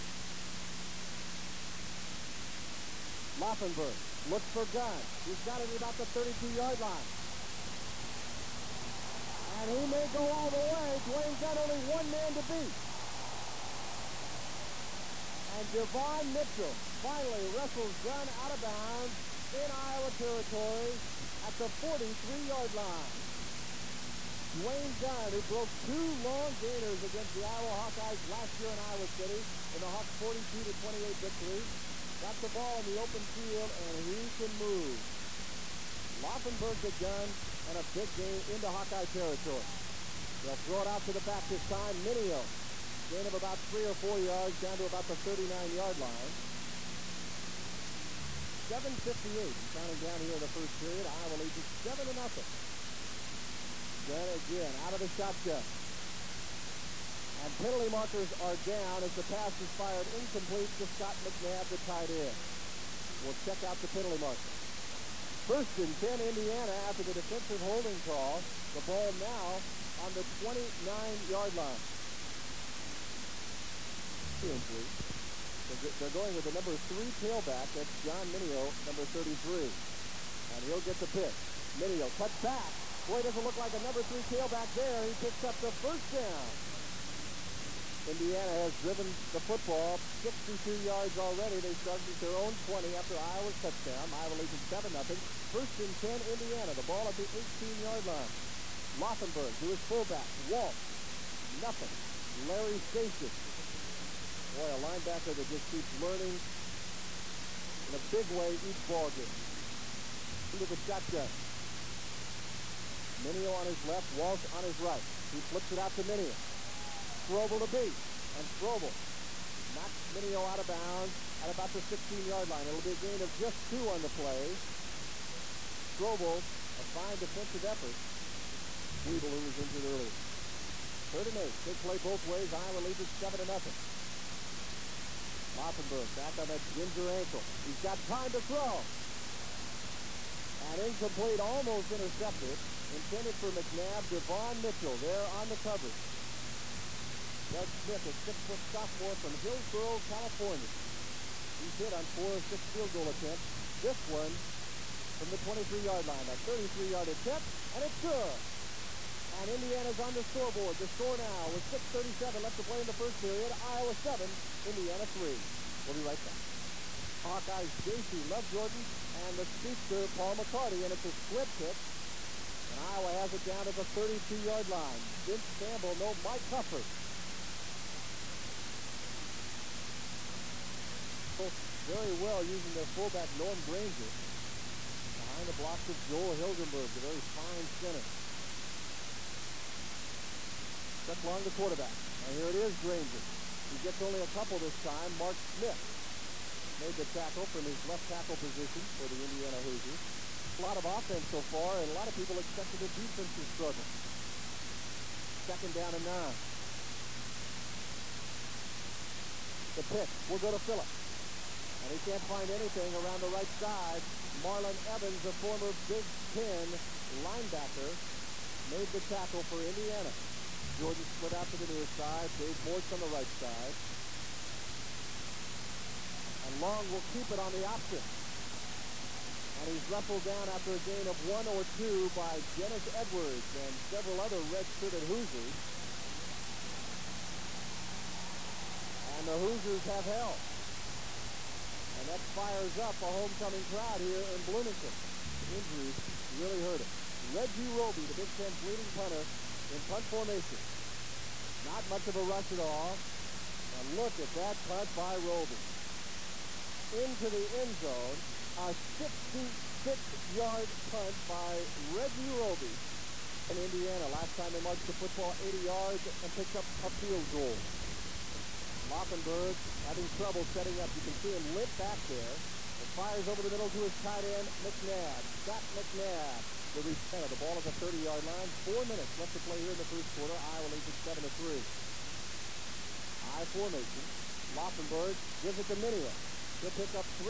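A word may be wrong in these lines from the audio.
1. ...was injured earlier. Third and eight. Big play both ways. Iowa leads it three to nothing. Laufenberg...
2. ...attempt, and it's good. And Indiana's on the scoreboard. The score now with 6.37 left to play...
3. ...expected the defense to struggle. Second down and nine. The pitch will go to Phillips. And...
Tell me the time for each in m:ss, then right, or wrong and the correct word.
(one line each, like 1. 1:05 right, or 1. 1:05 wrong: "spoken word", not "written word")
1. 2:09 wrong: "seven", not "three"
2. 2:37 right
3. 3:22 right.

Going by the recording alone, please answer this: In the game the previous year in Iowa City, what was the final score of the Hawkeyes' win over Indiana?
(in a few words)
42-28.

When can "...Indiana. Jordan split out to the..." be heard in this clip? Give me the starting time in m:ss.
3:39.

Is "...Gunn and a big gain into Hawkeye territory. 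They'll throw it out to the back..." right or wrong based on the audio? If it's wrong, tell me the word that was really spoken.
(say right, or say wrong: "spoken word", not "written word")
right.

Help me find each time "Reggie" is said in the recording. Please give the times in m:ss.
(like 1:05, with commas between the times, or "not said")
4:07, 4:21.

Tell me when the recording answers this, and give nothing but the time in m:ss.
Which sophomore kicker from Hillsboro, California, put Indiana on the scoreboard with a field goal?
2:27.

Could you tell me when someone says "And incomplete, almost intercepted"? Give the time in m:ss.
2:20.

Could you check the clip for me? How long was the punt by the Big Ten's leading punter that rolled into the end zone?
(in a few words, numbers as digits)
66 yards.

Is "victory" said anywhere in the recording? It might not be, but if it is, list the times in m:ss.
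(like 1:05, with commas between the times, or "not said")
0:31.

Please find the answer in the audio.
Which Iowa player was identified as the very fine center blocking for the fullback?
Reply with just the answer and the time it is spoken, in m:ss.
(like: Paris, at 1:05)
Joel Hilgenberg, at 3:06.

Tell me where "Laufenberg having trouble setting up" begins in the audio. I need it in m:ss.
4:28.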